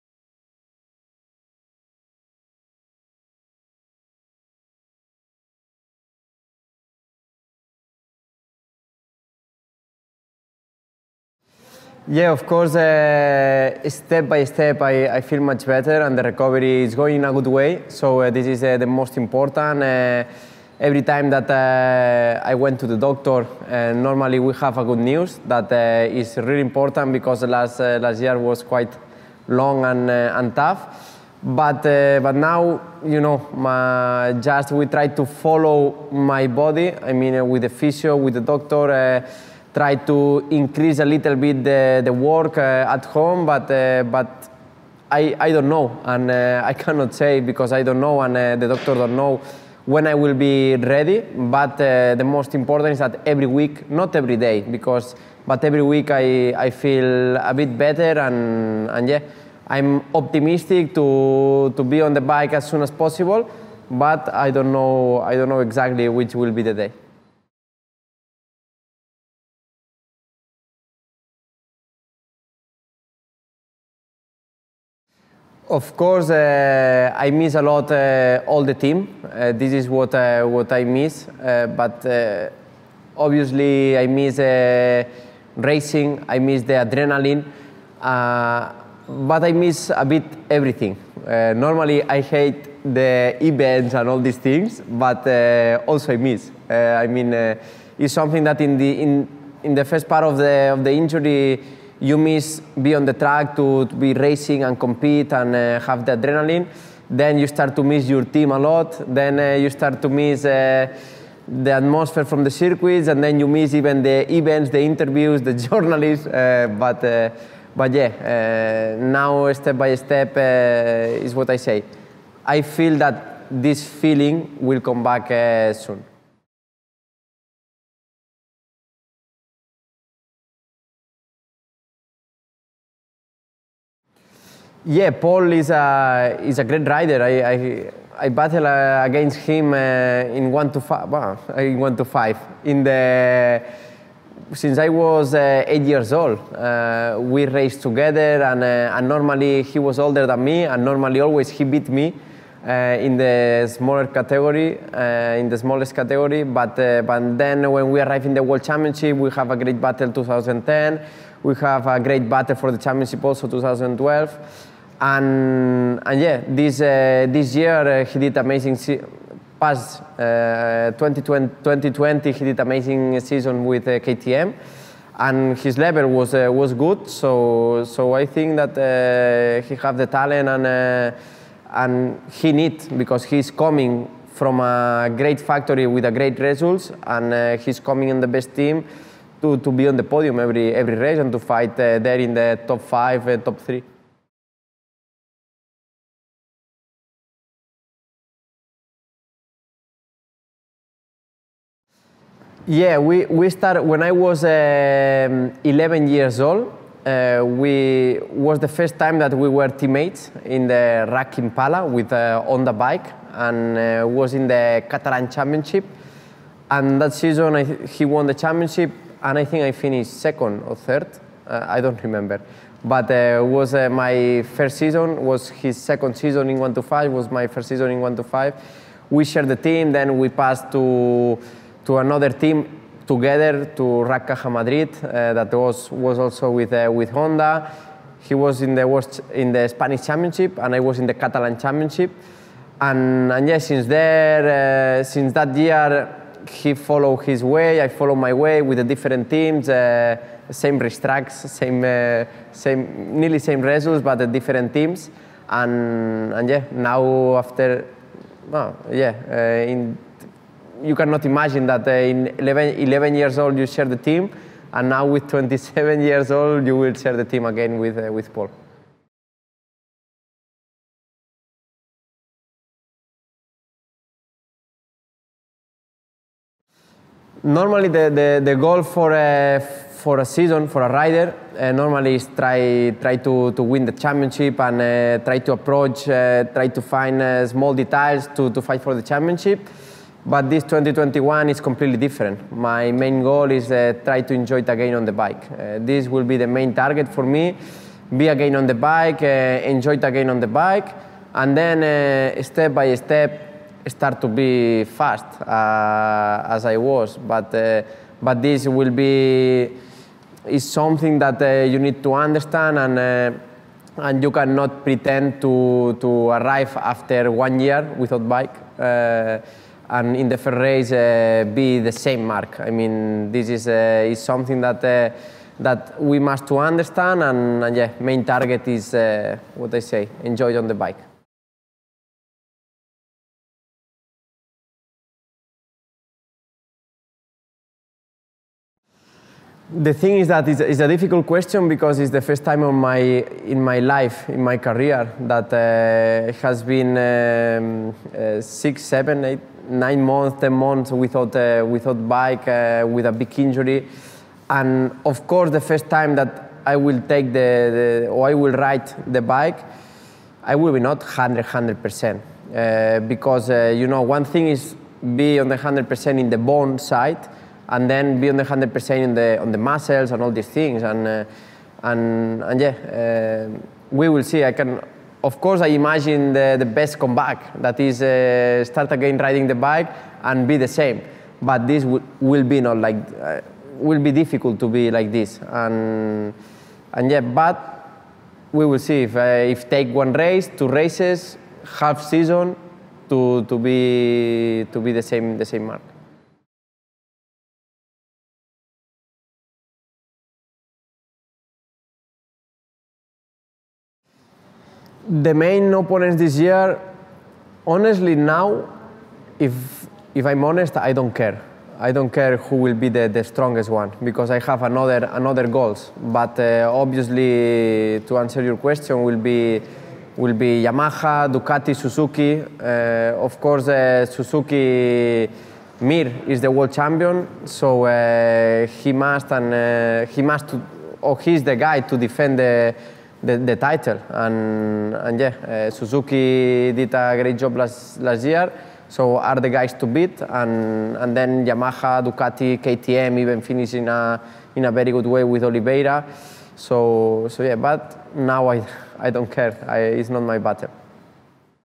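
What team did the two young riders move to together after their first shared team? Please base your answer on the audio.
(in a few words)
RACC Caja Madrid.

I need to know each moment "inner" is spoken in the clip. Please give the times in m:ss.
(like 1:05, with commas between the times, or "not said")
not said.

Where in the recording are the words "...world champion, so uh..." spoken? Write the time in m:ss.
7:06.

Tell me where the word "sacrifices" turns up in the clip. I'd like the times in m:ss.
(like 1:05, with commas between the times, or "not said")
not said.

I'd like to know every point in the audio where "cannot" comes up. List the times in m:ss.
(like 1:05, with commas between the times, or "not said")
0:46, 4:20, 5:14.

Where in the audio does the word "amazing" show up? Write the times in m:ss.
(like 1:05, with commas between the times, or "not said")
2:48, 2:52.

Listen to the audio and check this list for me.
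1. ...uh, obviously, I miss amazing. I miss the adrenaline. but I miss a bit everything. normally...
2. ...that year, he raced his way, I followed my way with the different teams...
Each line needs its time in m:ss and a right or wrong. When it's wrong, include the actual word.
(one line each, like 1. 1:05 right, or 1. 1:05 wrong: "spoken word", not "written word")
1. 1:22 wrong: "racing", not "amazing"
2. 4:05 wrong: "followed", not "raced".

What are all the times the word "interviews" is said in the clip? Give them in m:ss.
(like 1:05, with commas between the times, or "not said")
1:54.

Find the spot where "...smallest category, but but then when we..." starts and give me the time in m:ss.
2:35.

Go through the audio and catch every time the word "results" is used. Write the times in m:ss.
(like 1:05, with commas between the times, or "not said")
3:06, 4:13.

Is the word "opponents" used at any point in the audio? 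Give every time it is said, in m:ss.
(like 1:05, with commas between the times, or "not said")
6:45.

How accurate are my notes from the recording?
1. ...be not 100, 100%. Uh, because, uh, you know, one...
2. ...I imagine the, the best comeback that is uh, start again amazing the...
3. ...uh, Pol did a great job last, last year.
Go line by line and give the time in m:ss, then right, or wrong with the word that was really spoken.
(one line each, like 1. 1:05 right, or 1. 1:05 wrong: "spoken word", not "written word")
1. 6:00 right
2. 6:15 wrong: "riding", not "amazing"
3. 7:15 wrong: "Suzuki", not "Pol".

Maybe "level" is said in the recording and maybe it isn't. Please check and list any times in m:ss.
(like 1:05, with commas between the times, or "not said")
2:55.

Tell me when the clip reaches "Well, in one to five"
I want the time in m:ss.
2:21.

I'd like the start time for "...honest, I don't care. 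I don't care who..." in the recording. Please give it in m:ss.
6:50.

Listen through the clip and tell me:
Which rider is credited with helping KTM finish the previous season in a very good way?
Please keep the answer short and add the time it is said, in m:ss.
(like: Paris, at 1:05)
Oliveira, at 7:25.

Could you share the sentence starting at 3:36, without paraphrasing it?
And that season, I, he won the championship, and I think I finished second or third.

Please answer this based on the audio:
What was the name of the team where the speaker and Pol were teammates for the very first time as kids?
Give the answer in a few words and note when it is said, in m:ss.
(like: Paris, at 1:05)
RACC Impala, at 3:31.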